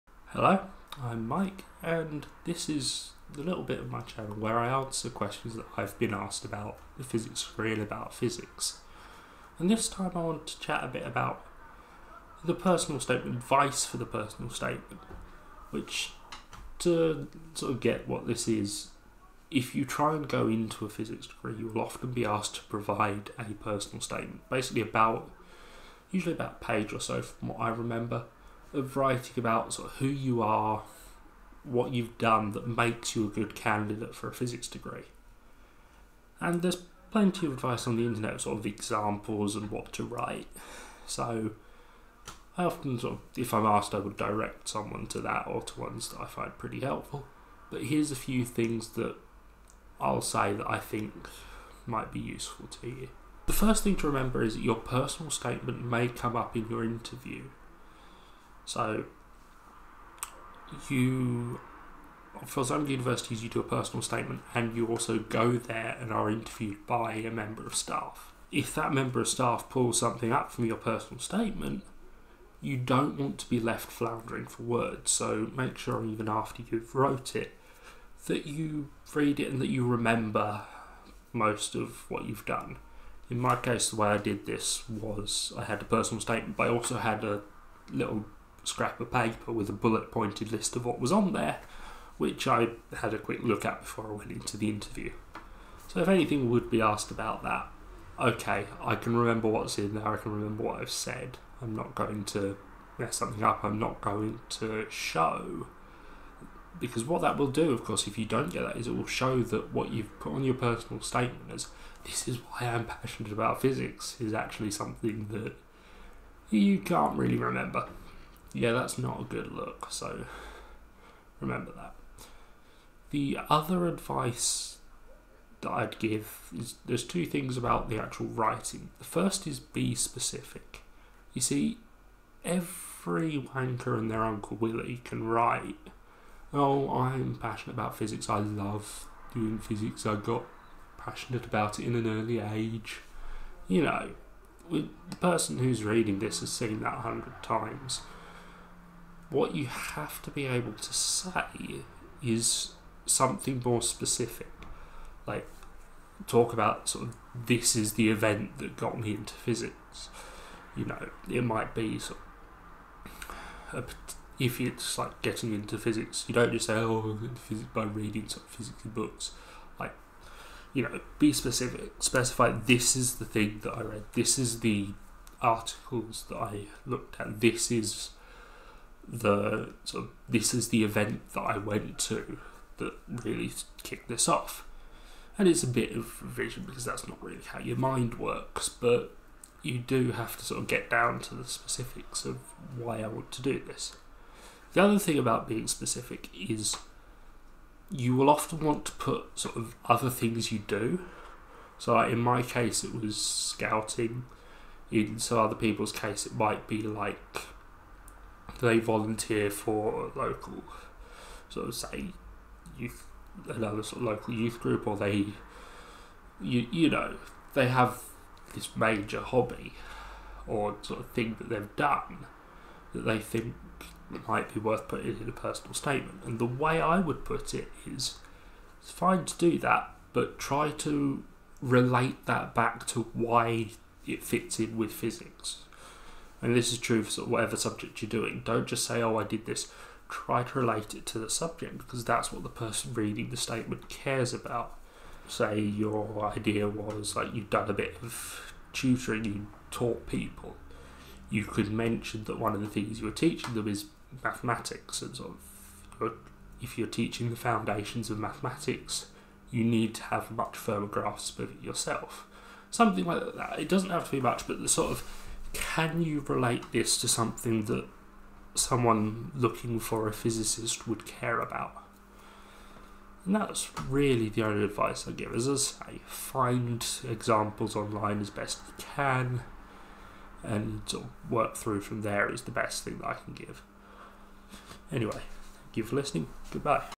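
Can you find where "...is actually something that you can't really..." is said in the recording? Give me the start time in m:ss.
1:54.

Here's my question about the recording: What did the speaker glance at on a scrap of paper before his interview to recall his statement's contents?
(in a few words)
A bullet pointed list.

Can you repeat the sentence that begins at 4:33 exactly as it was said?
And that's really the only advice I give.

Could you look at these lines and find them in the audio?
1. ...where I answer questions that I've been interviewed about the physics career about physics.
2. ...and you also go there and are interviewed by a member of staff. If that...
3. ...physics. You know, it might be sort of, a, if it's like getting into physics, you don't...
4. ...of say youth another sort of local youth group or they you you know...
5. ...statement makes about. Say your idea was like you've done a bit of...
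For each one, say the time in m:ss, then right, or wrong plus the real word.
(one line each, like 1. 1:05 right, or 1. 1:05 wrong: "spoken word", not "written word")
1. 0:04 wrong: "asked", not "interviewed"
2. 1:04 right
3. 2:39 right
4. 3:31 right
5. 4:03 wrong: "cares", not "makes".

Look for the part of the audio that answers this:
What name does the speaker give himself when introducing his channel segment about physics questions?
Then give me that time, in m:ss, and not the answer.
0:01.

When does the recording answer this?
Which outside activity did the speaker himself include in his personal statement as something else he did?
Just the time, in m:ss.
3:23.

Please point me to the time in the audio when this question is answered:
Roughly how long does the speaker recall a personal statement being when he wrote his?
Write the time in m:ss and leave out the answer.
0:26.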